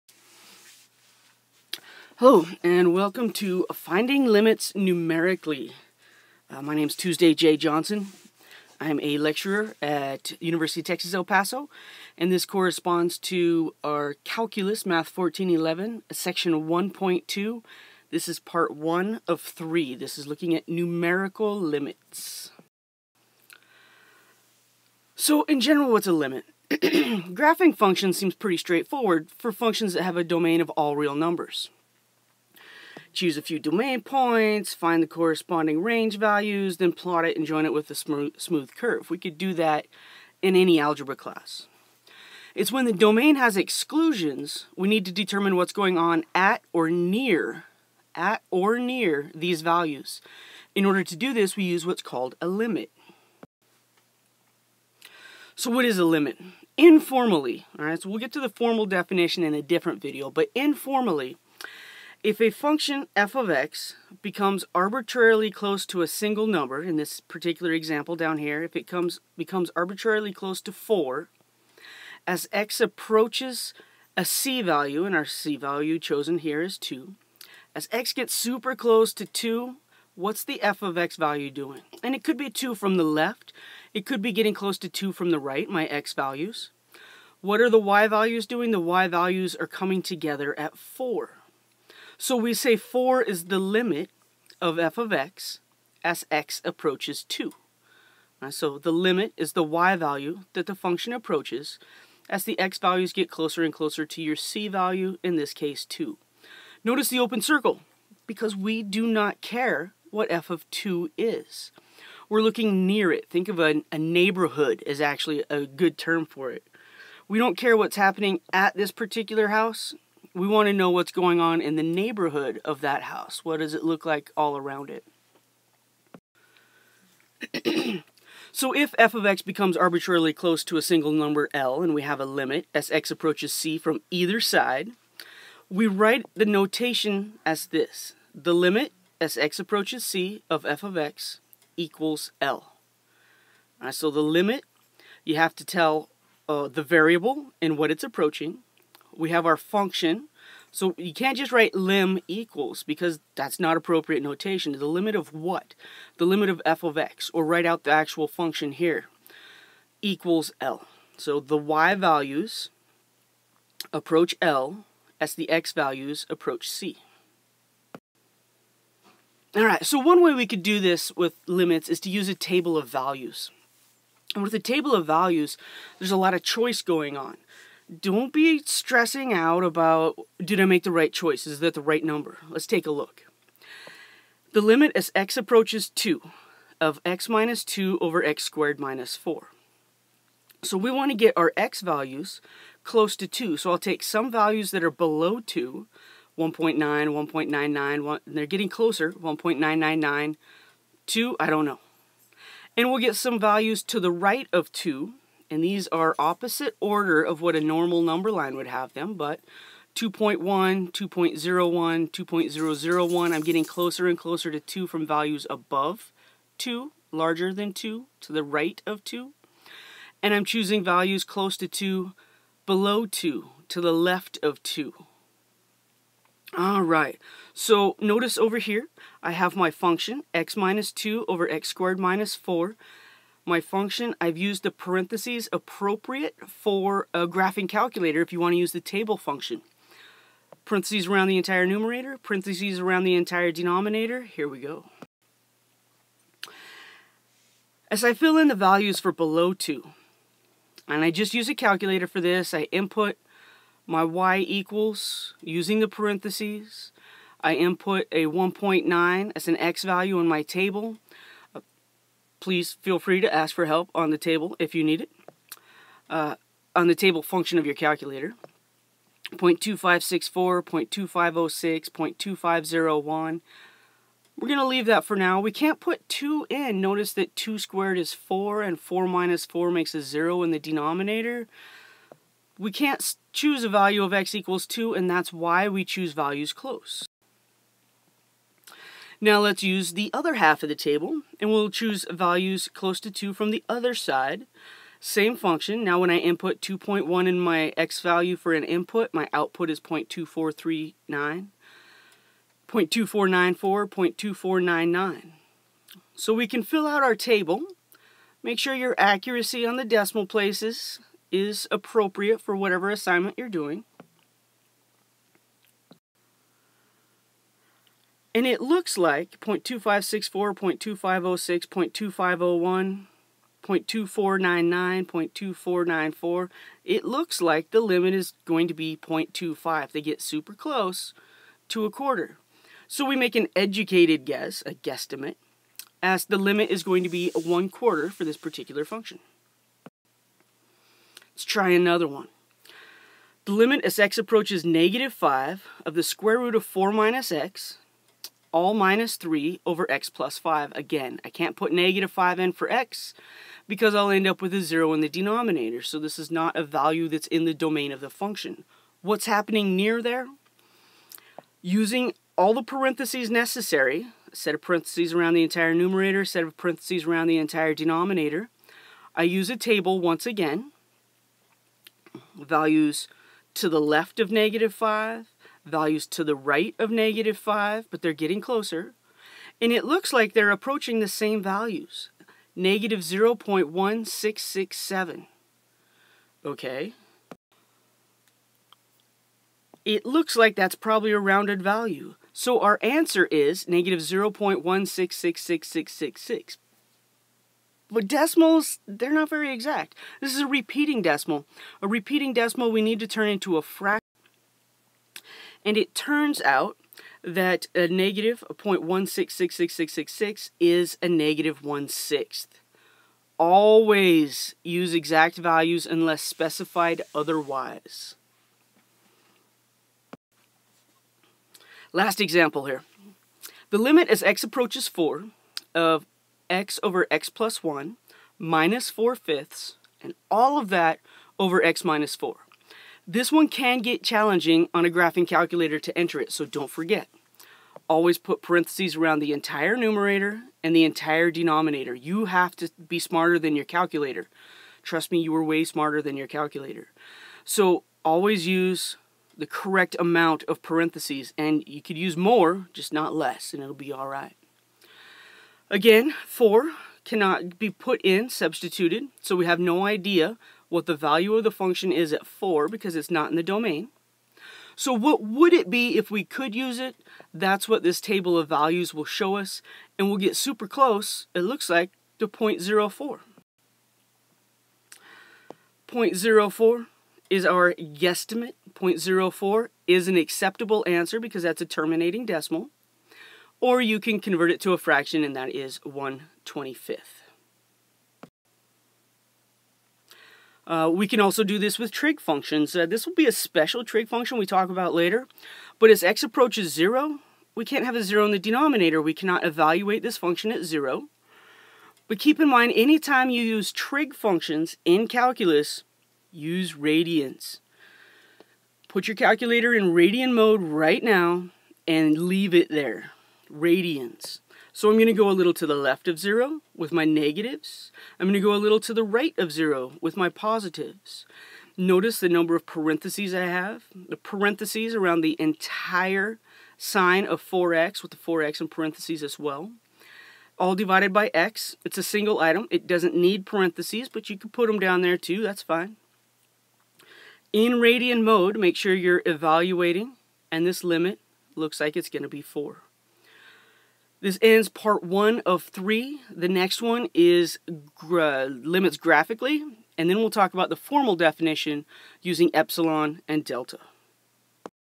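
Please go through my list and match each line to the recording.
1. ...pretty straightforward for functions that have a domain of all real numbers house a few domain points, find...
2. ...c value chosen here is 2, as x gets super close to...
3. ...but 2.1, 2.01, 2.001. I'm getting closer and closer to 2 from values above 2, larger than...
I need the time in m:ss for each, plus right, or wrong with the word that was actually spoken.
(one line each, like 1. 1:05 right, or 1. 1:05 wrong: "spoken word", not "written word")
1. 0:28 wrong: "choose", not "house"
2. 1:15 right
3. 3:29 right.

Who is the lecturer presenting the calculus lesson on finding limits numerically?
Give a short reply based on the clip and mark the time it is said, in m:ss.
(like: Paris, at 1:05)
Tuesday J. Johnson, at 0:06.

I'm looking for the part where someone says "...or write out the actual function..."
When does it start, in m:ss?
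2:37.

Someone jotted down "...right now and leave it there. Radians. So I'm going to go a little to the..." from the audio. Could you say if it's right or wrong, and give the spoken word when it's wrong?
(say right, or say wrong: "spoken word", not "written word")
right.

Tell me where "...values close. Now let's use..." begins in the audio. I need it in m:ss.
4:46.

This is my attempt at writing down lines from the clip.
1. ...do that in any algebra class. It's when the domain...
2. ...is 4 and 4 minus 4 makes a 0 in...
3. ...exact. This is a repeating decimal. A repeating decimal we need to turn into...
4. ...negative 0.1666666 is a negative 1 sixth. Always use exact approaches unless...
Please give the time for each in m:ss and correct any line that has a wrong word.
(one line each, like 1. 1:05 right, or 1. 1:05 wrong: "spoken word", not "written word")
1. 0:39 right
2. 4:37 right
3. 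6:39 right
4. 6:47 wrong: "values", not "approaches".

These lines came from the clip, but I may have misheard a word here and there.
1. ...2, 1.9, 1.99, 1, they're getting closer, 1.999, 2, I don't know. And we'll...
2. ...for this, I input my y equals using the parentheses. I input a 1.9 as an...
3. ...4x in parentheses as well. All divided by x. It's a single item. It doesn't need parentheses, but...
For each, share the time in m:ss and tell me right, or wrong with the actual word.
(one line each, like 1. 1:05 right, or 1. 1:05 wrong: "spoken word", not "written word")
1. 3:15 right
2. 4:12 right
3. 8:48 right.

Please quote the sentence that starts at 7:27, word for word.
So always use the correct amount of parentheses, and you could use more, just not less, and it'll be all right.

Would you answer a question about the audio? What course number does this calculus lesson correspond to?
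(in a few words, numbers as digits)
Math 1411.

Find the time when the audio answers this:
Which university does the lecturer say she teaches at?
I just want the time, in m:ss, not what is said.
0:10.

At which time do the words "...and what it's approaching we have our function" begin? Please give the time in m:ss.
2:27.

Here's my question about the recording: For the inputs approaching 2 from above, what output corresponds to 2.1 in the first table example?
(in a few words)
0.2439.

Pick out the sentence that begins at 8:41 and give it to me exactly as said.
Notice the number of parentheses I have.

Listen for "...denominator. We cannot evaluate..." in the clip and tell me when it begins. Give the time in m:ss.
8:18.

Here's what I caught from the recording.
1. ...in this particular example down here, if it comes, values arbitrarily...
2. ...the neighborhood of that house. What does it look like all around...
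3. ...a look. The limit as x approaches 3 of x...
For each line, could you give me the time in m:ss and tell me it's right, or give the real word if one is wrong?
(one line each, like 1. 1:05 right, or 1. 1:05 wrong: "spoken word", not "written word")
1. 1:06 wrong: "becomes", not "values"
2. 2:01 right
3. 3:02 wrong: "2", not "3".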